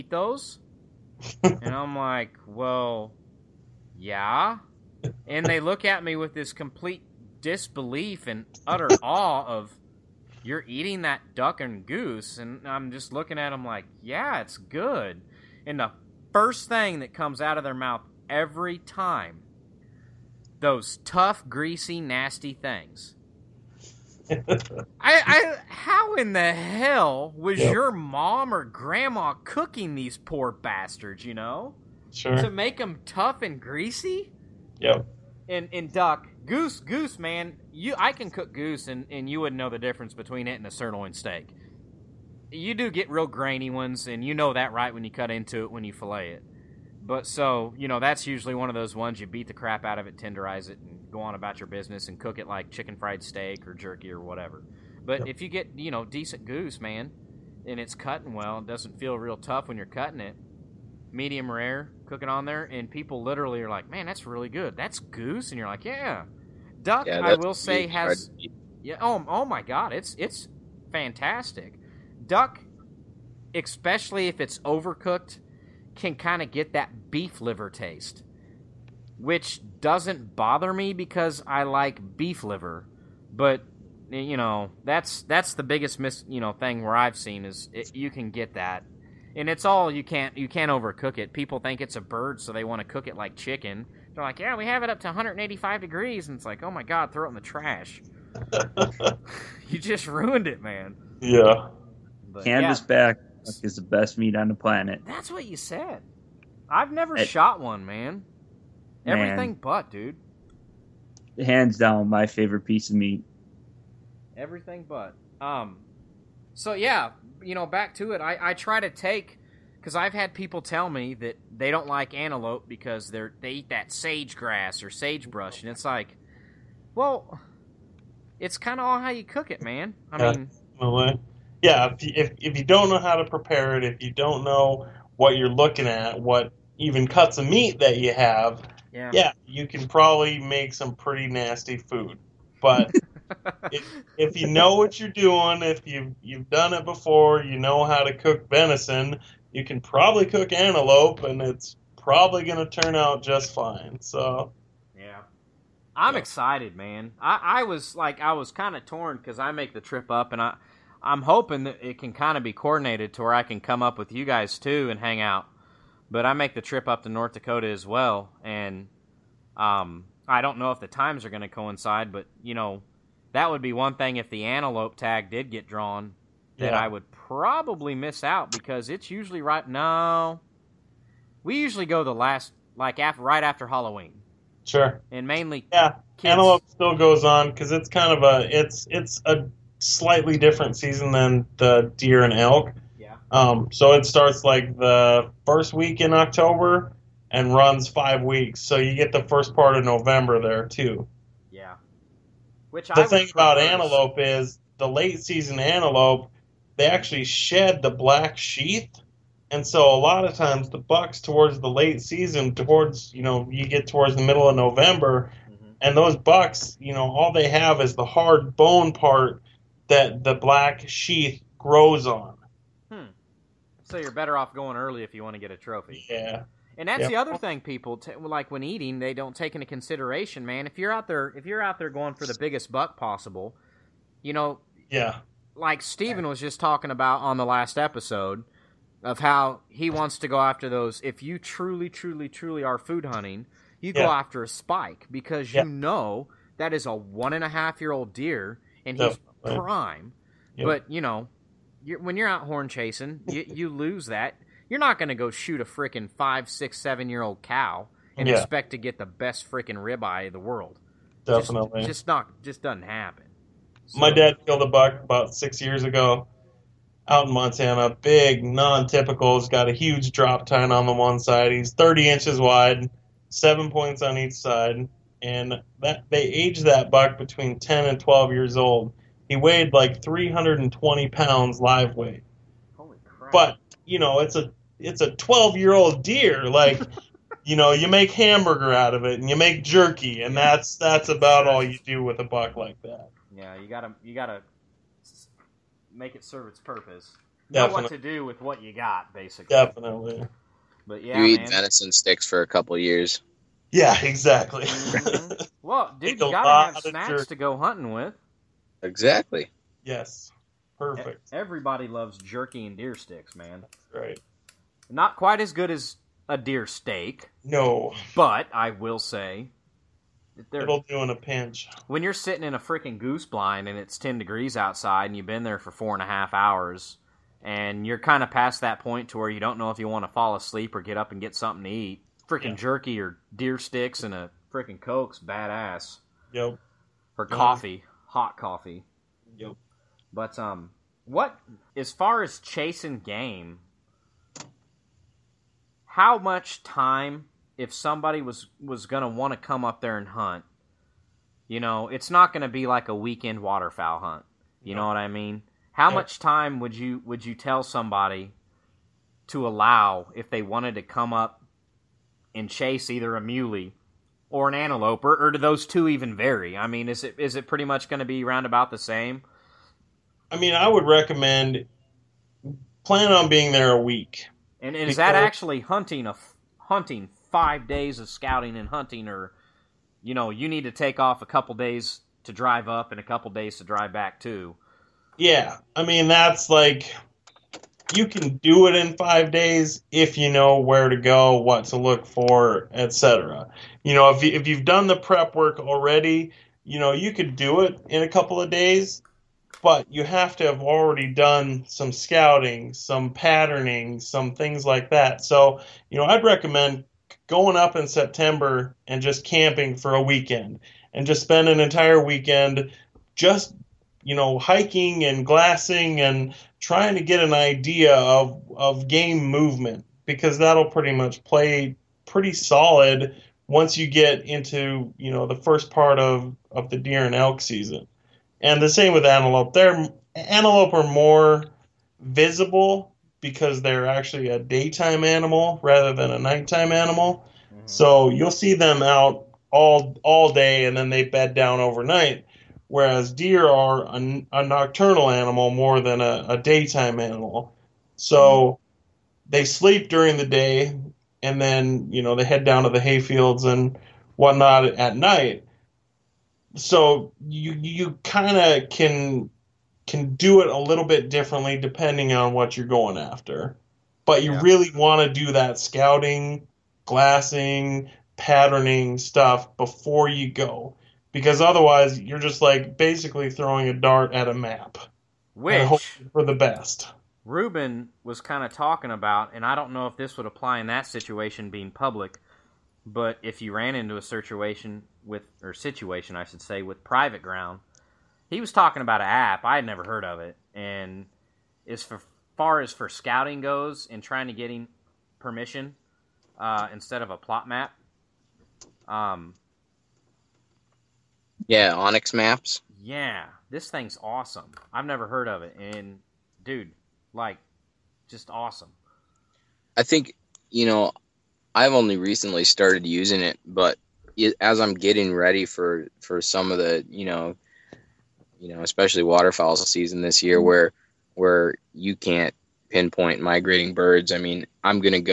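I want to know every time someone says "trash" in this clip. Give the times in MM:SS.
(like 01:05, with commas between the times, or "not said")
01:37.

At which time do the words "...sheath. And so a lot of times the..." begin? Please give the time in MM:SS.
03:28.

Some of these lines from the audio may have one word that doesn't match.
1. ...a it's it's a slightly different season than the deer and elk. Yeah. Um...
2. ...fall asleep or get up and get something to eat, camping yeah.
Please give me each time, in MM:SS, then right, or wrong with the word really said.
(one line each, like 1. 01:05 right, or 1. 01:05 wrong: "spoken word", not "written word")
1. 03:08 right
2. 05:30 wrong: "freaking", not "camping".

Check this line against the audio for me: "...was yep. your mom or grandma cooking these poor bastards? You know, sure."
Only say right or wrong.
right.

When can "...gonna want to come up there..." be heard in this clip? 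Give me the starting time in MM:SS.
05:48.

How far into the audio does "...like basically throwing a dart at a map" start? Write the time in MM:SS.
07:52.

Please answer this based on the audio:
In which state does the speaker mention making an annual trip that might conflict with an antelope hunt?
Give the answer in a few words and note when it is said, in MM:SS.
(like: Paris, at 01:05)
North Dakota, at 02:47.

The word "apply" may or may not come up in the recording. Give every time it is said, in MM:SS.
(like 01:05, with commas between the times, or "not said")
08:00.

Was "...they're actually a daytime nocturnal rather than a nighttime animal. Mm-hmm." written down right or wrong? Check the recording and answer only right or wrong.
wrong.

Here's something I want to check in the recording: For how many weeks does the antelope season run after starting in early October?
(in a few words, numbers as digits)
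5 weeks.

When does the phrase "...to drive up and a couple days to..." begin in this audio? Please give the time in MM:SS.
06:22.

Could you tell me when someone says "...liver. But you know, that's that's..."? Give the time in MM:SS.
01:22.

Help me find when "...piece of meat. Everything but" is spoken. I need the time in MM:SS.
01:52.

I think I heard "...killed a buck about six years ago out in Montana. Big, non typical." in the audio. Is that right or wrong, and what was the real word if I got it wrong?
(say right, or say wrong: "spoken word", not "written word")
right.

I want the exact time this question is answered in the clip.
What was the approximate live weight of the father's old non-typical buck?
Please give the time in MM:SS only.
04:40.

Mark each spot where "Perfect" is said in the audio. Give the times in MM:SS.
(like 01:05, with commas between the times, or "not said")
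05:10.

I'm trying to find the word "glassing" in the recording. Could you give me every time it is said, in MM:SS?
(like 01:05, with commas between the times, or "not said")
06:55, 07:46.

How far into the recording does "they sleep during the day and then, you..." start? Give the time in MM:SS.
07:29.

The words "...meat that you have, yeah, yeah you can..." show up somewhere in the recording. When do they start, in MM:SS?
02:17.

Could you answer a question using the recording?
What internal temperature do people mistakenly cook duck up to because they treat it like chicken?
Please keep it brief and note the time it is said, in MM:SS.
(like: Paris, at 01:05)
185 degrees, at 01:35.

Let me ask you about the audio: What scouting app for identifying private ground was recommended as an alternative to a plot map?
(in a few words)
onX maps.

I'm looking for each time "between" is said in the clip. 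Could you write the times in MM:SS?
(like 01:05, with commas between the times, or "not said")
00:40, 04:37.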